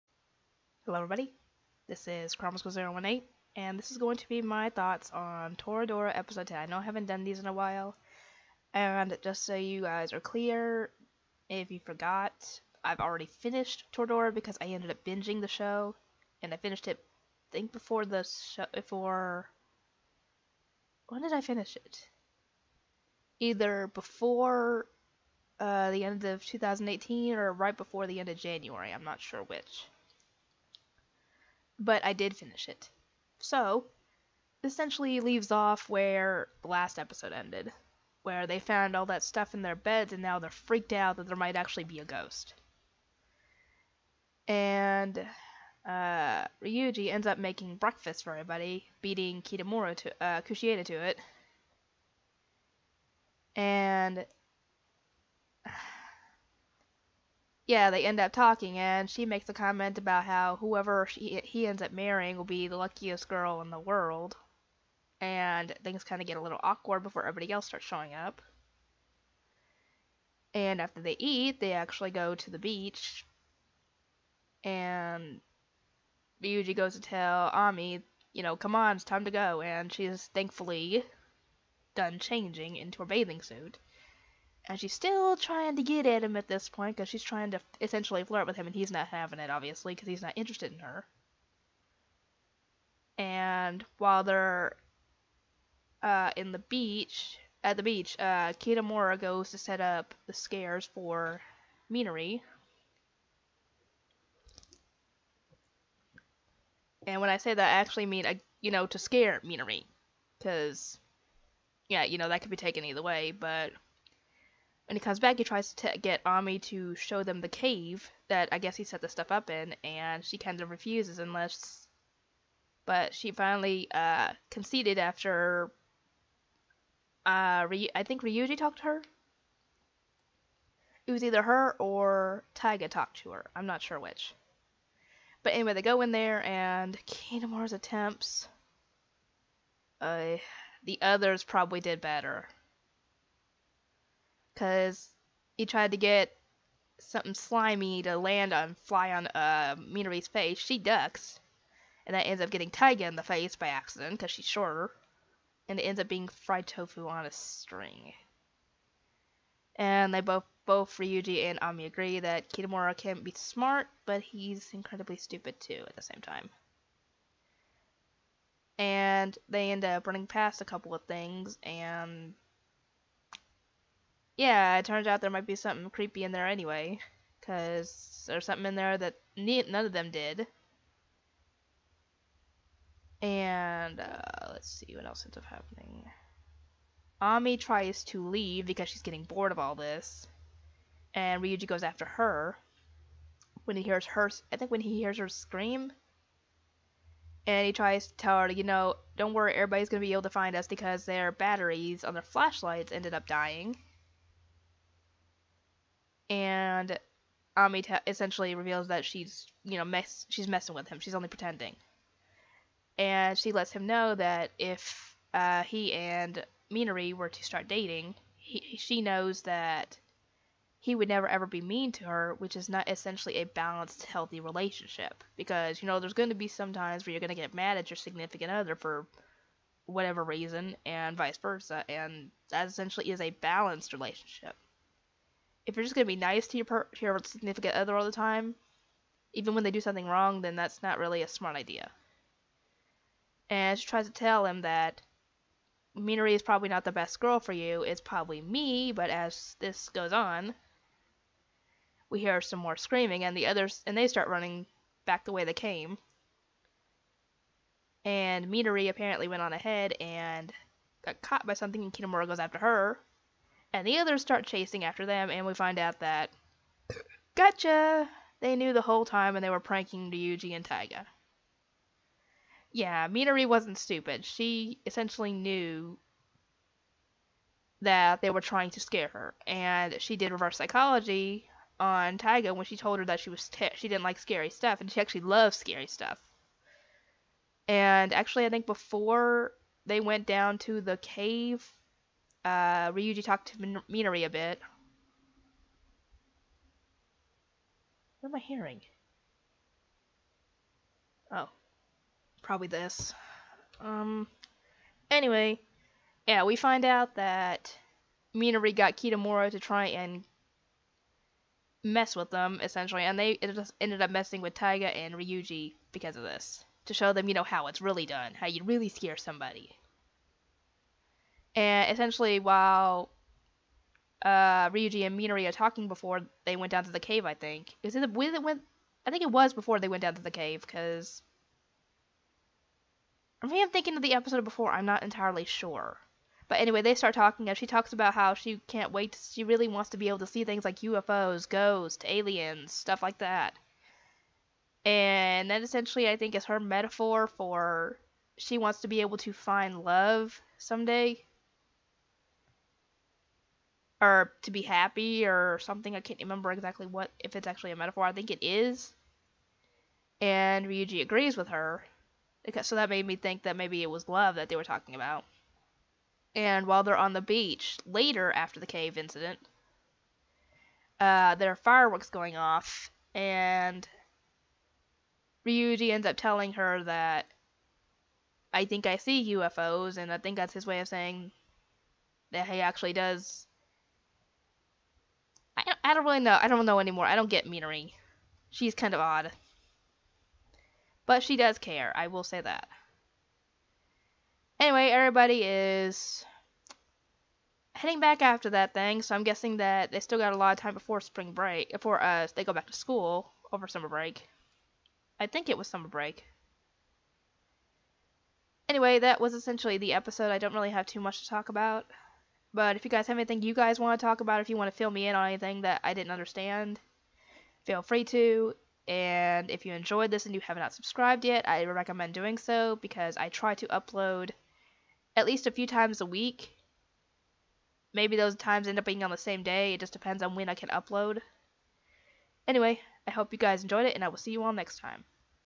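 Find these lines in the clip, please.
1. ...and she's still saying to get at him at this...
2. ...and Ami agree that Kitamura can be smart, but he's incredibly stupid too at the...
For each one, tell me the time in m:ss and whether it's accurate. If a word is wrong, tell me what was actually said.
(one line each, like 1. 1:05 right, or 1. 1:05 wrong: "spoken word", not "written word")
1. 1:24 wrong: "trying", not "saying"
2. 2:41 right.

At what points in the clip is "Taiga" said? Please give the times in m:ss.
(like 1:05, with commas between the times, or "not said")
2:12, 2:32, 4:30, 4:42, 5:14.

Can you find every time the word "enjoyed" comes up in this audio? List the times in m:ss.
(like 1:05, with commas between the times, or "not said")
6:59, 7:13.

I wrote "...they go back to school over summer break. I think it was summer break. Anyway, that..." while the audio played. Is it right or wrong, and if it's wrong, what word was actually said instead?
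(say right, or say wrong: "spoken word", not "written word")
right.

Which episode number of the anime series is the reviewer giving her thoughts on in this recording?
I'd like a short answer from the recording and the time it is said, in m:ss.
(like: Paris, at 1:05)
10, at 0:06.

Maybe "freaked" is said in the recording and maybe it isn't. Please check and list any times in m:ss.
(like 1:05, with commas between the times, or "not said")
0:40.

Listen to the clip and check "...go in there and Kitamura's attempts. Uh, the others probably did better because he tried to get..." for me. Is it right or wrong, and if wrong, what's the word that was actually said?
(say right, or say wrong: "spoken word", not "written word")
right.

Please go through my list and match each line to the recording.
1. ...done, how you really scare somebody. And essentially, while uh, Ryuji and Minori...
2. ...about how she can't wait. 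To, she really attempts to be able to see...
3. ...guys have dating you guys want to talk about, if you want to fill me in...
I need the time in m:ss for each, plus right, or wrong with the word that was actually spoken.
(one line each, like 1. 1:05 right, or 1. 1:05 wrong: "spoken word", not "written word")
1. 5:18 right
2. 5:37 wrong: "wants", not "attempts"
3. 6:52 wrong: "anything", not "dating".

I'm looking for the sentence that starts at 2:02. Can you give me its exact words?
But she finally uh, conceded after.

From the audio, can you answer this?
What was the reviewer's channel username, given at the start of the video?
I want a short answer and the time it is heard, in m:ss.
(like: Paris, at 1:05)
kuramasgurl018, at 0:02.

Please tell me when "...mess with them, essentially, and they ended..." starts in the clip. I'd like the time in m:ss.
5:11.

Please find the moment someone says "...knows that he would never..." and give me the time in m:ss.
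3:39.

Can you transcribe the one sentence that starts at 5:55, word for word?
I can't remember exactly what if it's actually a metaphor.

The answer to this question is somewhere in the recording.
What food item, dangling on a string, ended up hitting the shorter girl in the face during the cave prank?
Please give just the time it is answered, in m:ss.
2:36.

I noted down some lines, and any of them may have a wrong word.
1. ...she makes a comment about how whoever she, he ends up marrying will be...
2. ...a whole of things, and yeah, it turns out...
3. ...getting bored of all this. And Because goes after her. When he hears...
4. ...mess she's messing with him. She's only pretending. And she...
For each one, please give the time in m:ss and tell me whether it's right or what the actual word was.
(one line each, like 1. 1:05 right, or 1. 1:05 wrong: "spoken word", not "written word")
1. 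0:59 right
2. 2:50 wrong: "couple", not "whole"
3. 3:09 wrong: "Ryuji", not "Because"
4. 3:29 right.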